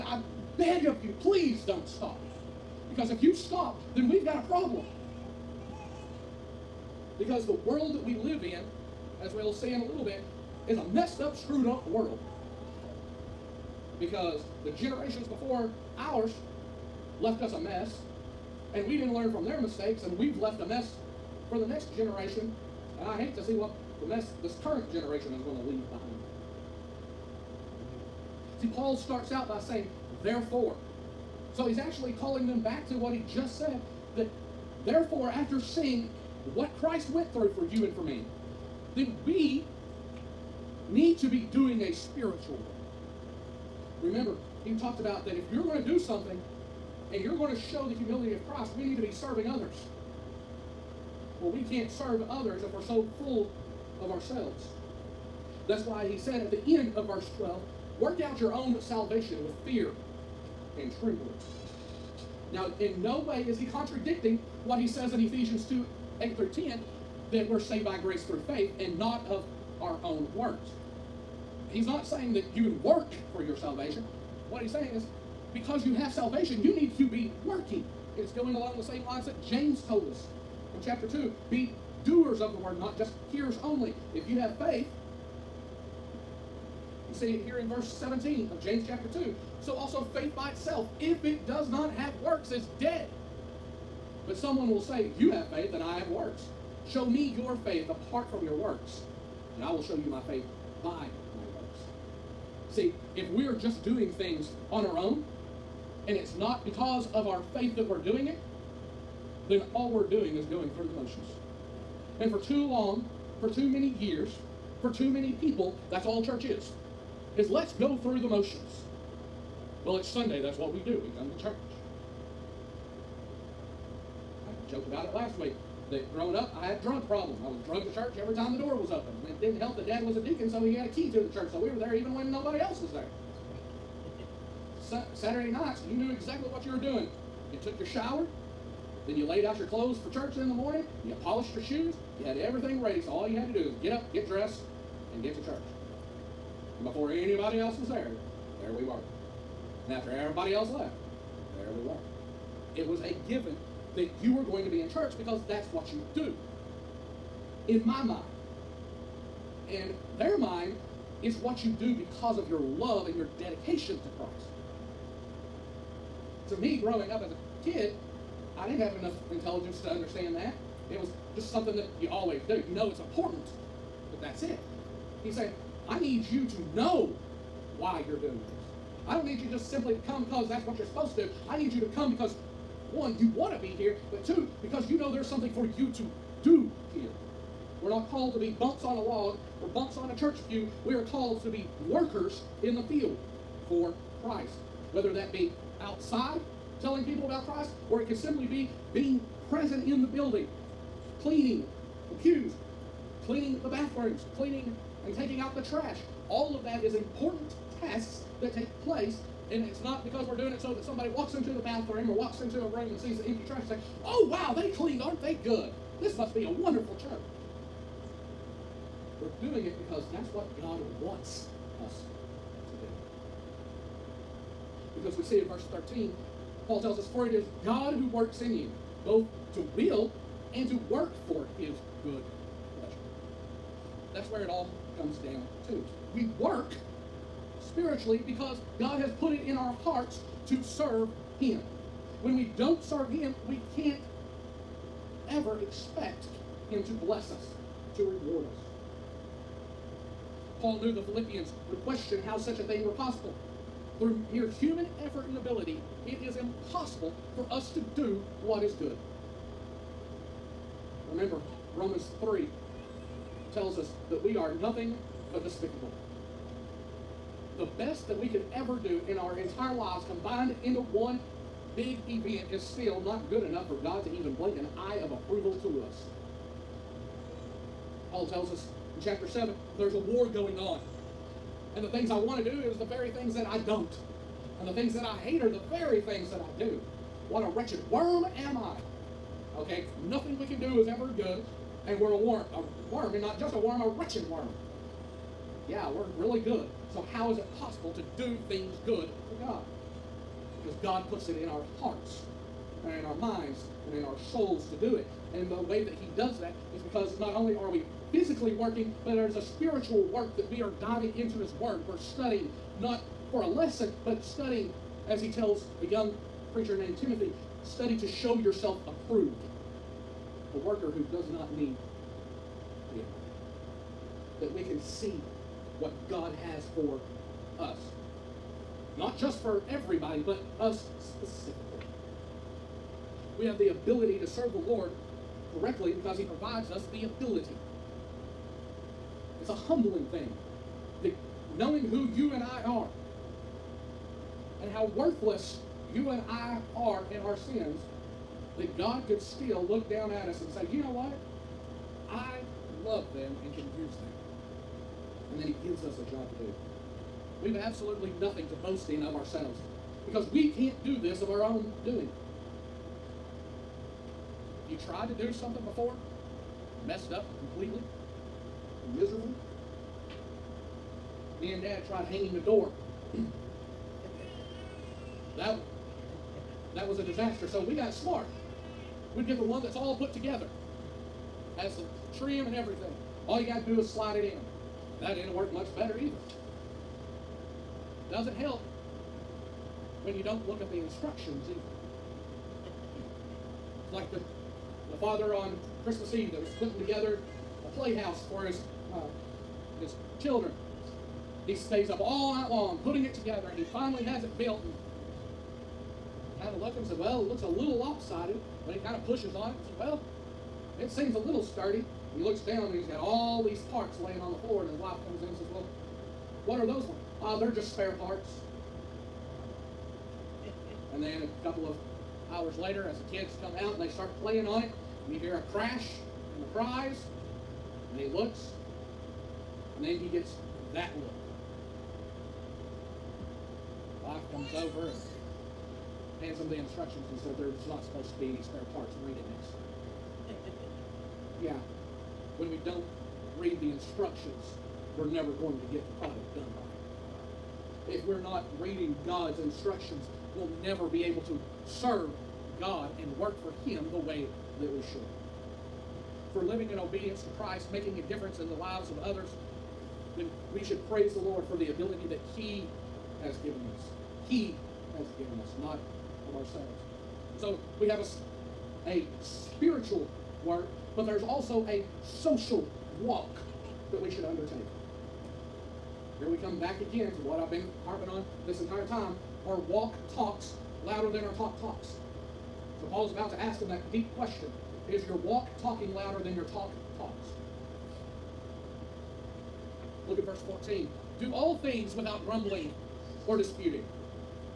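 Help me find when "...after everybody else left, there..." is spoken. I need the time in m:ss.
2:29.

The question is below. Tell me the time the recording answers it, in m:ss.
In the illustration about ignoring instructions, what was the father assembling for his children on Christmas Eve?
6:37.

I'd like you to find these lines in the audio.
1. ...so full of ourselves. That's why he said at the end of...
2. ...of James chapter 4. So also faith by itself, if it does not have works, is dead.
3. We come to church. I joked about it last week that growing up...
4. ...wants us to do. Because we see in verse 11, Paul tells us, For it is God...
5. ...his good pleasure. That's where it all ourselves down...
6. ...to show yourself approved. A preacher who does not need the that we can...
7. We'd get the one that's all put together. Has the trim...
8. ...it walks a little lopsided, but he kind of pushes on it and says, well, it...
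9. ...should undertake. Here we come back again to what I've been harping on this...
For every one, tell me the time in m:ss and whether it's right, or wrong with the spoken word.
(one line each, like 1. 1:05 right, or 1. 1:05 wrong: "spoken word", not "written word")
1. 0:52 right
2. 1:28 wrong: "2", not "4"
3. 2:01 right
4. 3:40 wrong: "13", not "11"
5. 3:51 wrong: "comes", not "ourselves"
6. 5:17 wrong: "worker", not "preacher"
7. 6:19 right
8. 6:47 wrong: "looks", not "walks"
9. 7:54 right.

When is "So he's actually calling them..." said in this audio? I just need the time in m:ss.
0:31.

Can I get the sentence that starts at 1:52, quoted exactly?
And for too long, for too many years, for too many people, that's all church is.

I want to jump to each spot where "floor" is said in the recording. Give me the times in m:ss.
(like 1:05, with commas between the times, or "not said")
6:54.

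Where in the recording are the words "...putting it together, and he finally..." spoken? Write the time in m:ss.
6:42.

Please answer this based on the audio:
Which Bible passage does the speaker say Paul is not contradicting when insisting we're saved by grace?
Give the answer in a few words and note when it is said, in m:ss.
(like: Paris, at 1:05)
Ephesians 2:8-10, at 1:05.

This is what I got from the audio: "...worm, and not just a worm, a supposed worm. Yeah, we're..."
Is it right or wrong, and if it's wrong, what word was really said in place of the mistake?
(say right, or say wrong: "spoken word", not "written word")
wrong: "wretched", not "supposed".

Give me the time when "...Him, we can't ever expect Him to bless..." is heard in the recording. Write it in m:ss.
4:03.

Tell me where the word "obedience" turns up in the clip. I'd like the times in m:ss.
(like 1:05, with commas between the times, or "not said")
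7:36.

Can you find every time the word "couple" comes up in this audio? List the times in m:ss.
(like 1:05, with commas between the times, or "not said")
7:01.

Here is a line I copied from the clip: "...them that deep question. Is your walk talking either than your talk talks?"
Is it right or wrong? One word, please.
wrong.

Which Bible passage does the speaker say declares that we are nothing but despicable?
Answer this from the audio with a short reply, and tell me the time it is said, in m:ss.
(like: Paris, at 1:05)
Romans 3, at 4:21.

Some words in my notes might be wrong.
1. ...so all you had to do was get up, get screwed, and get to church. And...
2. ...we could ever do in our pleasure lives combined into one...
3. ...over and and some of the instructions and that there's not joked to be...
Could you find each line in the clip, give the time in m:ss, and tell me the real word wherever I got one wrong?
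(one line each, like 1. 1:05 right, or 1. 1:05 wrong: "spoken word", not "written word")
1. 2:23 wrong: "dressed", not "screwed"
2. 4:28 wrong: "entire", not "pleasure"
3. 7:14 wrong: "supposed", not "joked".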